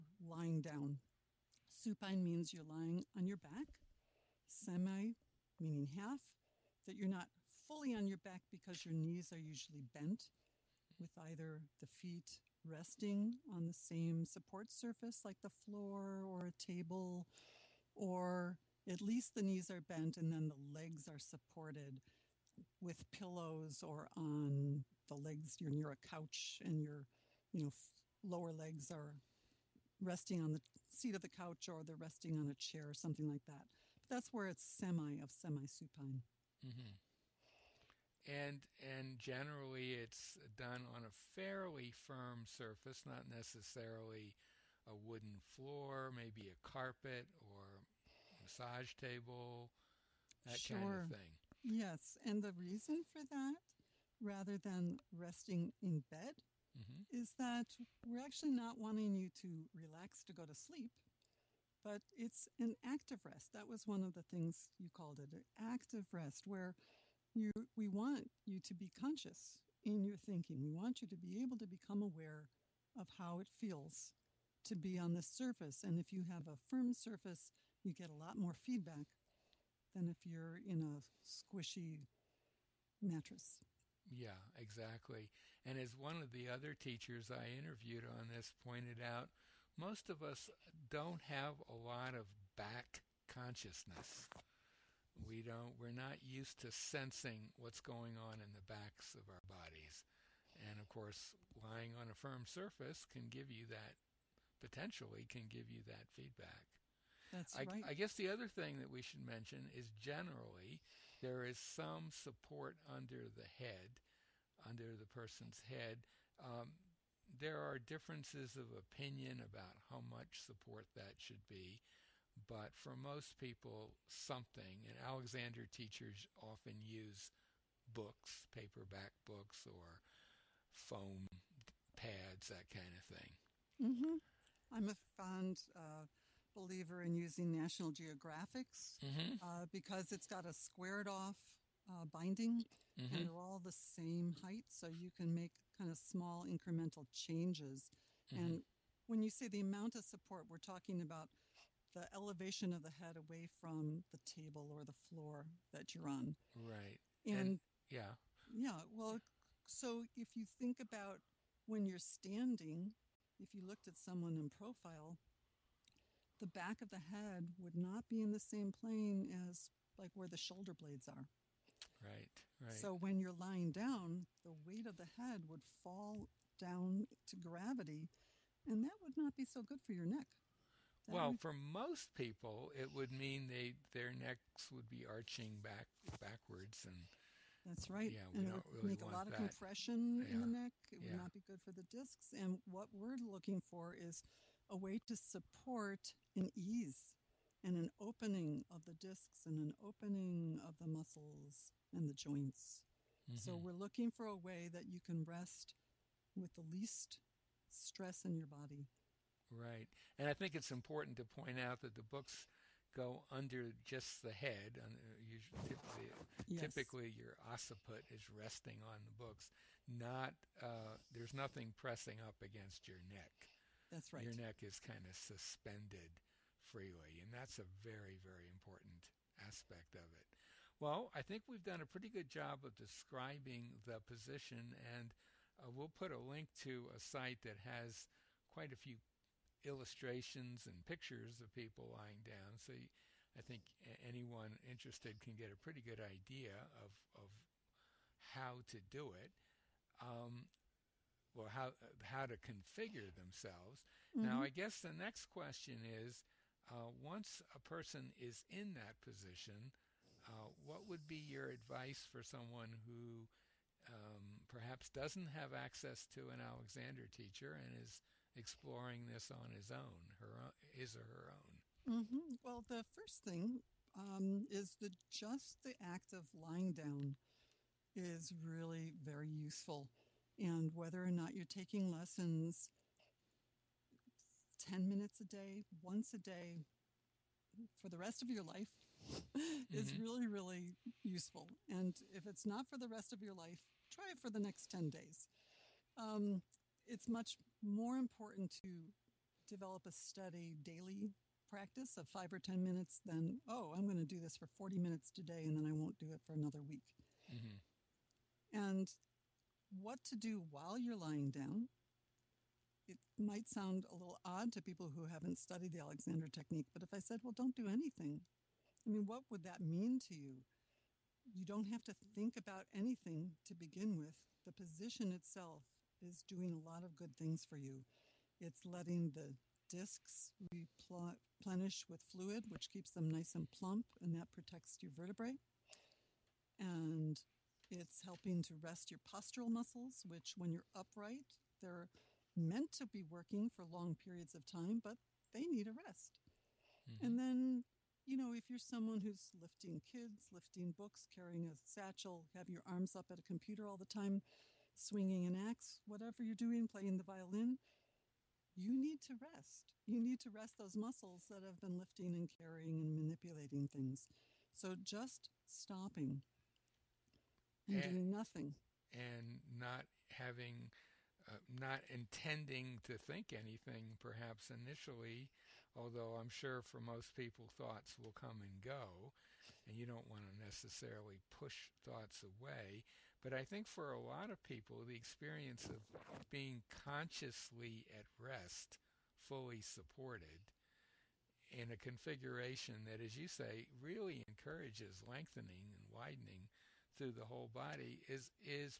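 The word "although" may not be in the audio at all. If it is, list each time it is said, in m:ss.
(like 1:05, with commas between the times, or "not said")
6:15.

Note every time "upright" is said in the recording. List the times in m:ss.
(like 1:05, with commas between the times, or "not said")
5:40.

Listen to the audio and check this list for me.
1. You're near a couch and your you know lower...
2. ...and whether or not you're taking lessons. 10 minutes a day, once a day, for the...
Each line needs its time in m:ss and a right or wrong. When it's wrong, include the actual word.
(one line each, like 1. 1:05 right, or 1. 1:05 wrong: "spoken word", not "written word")
1. 0:25 right
2. 4:40 right.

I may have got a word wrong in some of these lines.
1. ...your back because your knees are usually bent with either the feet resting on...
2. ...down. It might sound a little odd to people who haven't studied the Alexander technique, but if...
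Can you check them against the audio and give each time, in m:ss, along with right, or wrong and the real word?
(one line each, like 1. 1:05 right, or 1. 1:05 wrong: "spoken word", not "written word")
1. 0:08 right
2. 5:11 right.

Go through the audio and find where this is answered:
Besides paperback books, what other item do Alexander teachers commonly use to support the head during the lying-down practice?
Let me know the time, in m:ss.
2:10.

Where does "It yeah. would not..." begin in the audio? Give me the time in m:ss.
3:10.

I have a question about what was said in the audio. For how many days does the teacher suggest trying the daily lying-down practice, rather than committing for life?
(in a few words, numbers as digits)
10 days.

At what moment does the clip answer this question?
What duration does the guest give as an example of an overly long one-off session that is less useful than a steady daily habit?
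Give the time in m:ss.
5:04.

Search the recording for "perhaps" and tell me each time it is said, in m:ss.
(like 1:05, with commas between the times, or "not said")
4:24, 6:13.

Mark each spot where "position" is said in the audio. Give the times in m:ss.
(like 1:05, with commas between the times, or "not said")
3:53, 4:18, 5:24.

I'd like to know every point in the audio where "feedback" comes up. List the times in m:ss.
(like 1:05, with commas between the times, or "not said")
1:18, 1:46.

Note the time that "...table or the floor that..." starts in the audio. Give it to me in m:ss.
2:34.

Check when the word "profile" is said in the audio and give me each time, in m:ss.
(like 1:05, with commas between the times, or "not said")
2:44.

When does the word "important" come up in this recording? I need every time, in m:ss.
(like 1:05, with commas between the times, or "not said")
3:30, 3:48, 4:57.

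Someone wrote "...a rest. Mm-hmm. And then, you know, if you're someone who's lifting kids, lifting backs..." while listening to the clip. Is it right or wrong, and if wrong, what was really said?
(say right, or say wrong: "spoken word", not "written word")
wrong: "books", not "backs".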